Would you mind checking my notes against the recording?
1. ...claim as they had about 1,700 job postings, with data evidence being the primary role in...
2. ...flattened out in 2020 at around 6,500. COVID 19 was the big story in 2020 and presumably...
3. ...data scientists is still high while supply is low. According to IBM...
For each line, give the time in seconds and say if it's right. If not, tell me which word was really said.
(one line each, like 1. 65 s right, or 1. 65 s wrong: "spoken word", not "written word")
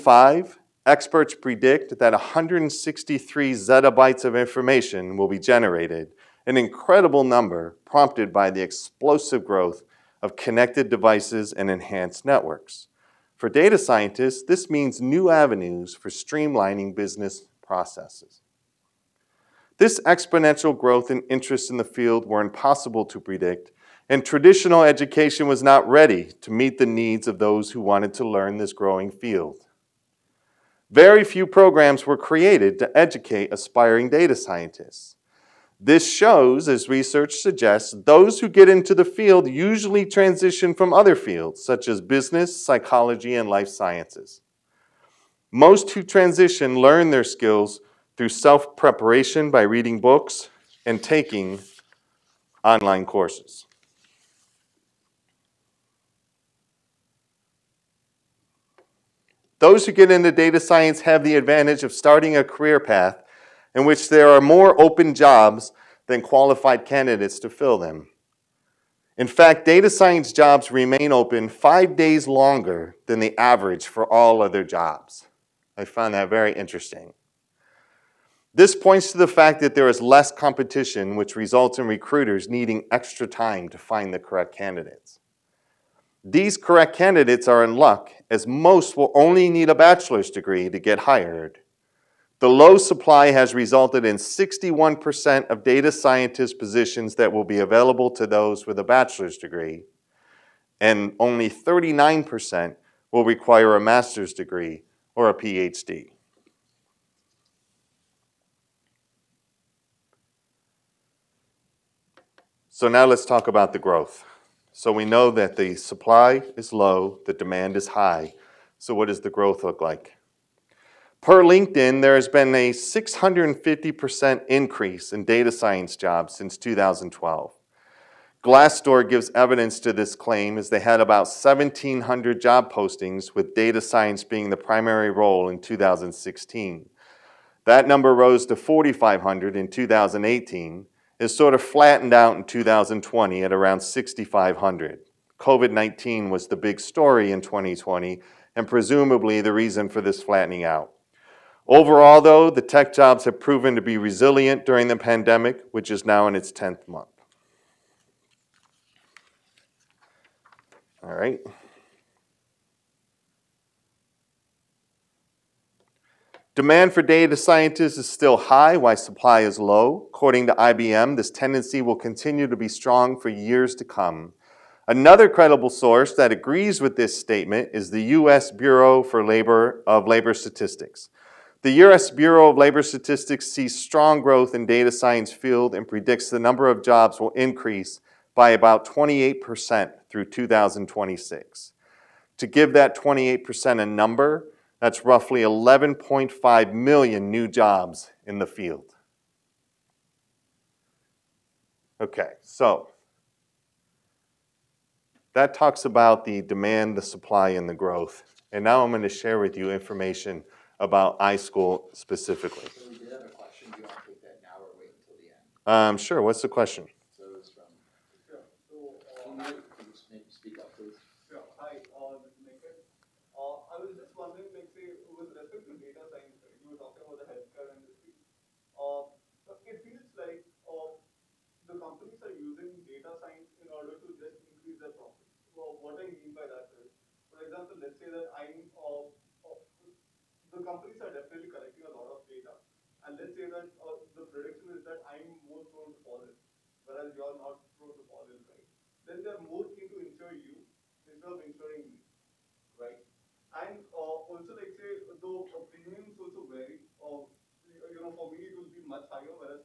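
1. 130 s wrong: "science", not "evidence"
2. 141 s right
3. 167 s right.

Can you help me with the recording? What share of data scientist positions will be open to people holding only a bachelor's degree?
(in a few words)
61%.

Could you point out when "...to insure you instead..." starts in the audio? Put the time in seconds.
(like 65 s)
249 s.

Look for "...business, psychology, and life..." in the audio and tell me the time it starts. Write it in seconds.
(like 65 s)
42 s.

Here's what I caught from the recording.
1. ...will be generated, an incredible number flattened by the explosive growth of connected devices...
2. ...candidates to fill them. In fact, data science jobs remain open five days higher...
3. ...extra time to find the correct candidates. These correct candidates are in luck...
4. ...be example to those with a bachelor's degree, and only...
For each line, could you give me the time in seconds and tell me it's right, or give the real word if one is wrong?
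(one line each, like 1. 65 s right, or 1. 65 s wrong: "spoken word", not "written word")
1. 5 s wrong: "prompted", not "flattened"
2. 66 s wrong: "longer", not "higher"
3. 82 s right
4. 97 s wrong: "available", not "example".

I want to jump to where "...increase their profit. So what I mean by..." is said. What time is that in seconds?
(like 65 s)
234 s.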